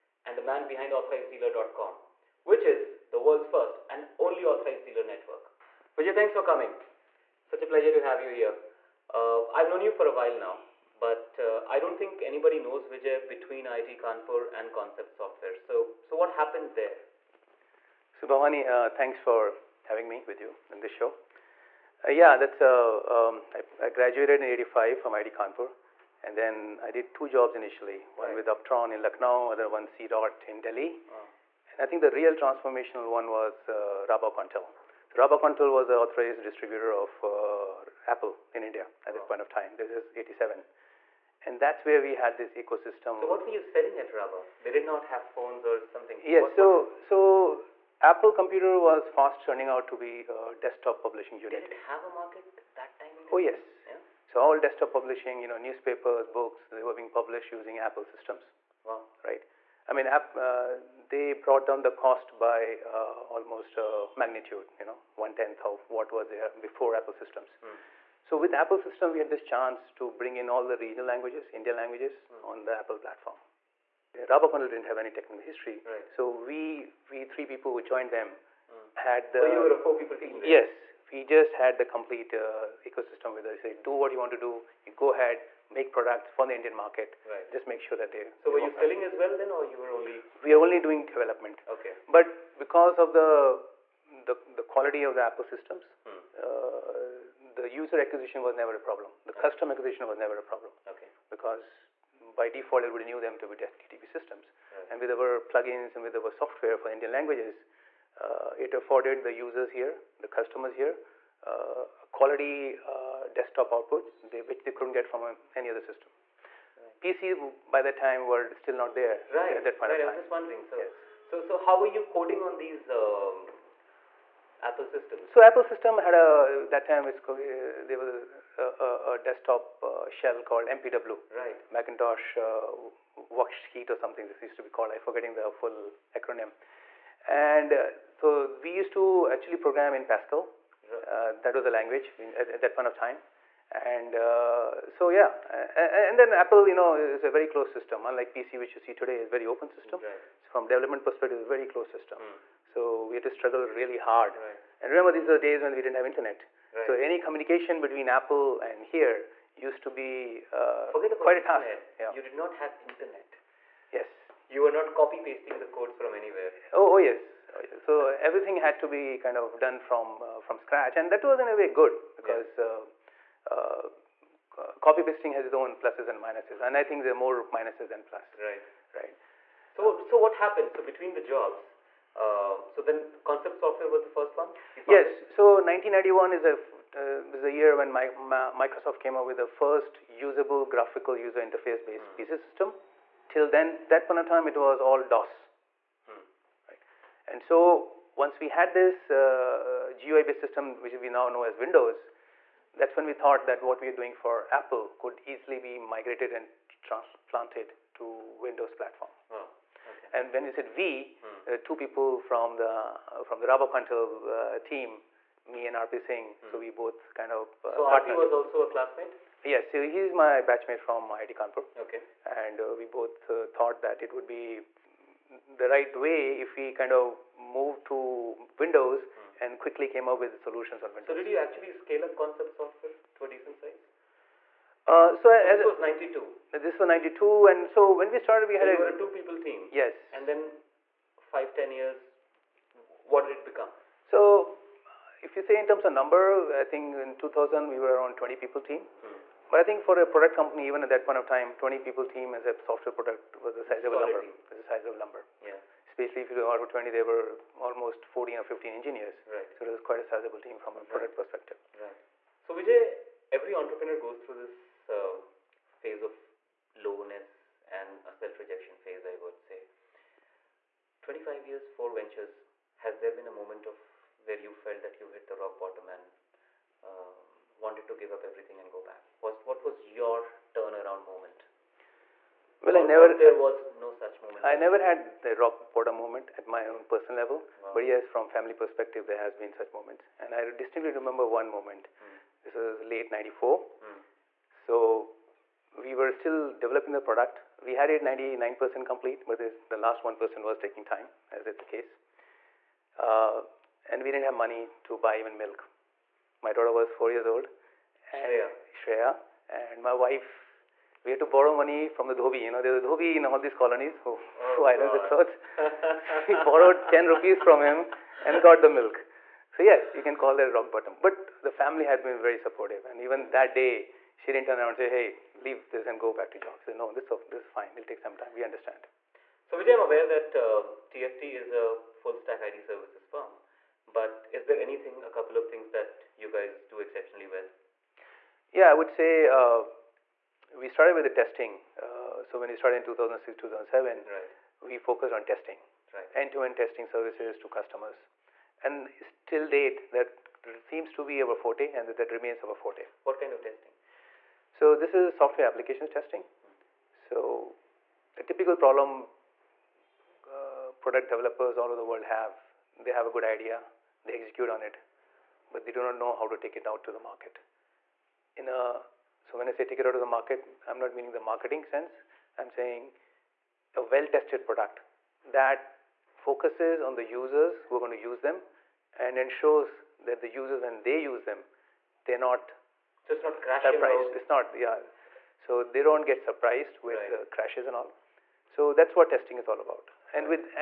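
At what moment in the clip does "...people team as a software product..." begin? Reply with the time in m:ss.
4:11.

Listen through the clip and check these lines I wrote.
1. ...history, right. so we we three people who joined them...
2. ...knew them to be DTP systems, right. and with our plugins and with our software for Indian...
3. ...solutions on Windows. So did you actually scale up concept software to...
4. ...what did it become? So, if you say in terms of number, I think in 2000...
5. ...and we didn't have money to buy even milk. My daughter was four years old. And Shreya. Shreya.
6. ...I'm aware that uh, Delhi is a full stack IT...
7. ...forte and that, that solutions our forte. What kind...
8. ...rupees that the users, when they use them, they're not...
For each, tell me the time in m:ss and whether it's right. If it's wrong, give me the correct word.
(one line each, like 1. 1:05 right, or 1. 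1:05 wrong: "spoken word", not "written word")
1. 1:15 right
2. 1:43 right
3. 3:50 right
4. 4:03 right
5. 5:03 right
6. 5:29 wrong: "TFT", not "Delhi"
7. 5:51 wrong: "remains", not "solutions"
8. 6:19 wrong: "ensures", not "rupees".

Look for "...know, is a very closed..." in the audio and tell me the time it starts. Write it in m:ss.
2:26.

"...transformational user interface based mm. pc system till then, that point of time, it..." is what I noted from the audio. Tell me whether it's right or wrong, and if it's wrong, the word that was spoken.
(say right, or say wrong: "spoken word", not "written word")
wrong: "graphical", not "transformational".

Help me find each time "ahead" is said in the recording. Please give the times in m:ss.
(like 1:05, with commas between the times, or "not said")
1:25.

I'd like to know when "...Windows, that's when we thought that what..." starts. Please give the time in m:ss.
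3:21.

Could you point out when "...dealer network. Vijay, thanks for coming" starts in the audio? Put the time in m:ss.
0:04.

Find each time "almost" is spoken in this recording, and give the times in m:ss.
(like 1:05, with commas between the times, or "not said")
1:03, 4:17.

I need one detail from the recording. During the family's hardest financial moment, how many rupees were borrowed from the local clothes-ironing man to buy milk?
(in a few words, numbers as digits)
10 rupees.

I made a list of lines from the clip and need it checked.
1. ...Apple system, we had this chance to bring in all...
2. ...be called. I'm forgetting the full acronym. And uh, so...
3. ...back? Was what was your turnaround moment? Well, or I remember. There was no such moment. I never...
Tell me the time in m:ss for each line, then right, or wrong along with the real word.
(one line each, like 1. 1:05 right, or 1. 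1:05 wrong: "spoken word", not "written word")
1. 1:08 right
2. 2:14 right
3. 4:38 wrong: "never", not "remember".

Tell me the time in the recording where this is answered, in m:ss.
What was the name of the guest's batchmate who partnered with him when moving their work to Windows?
3:35.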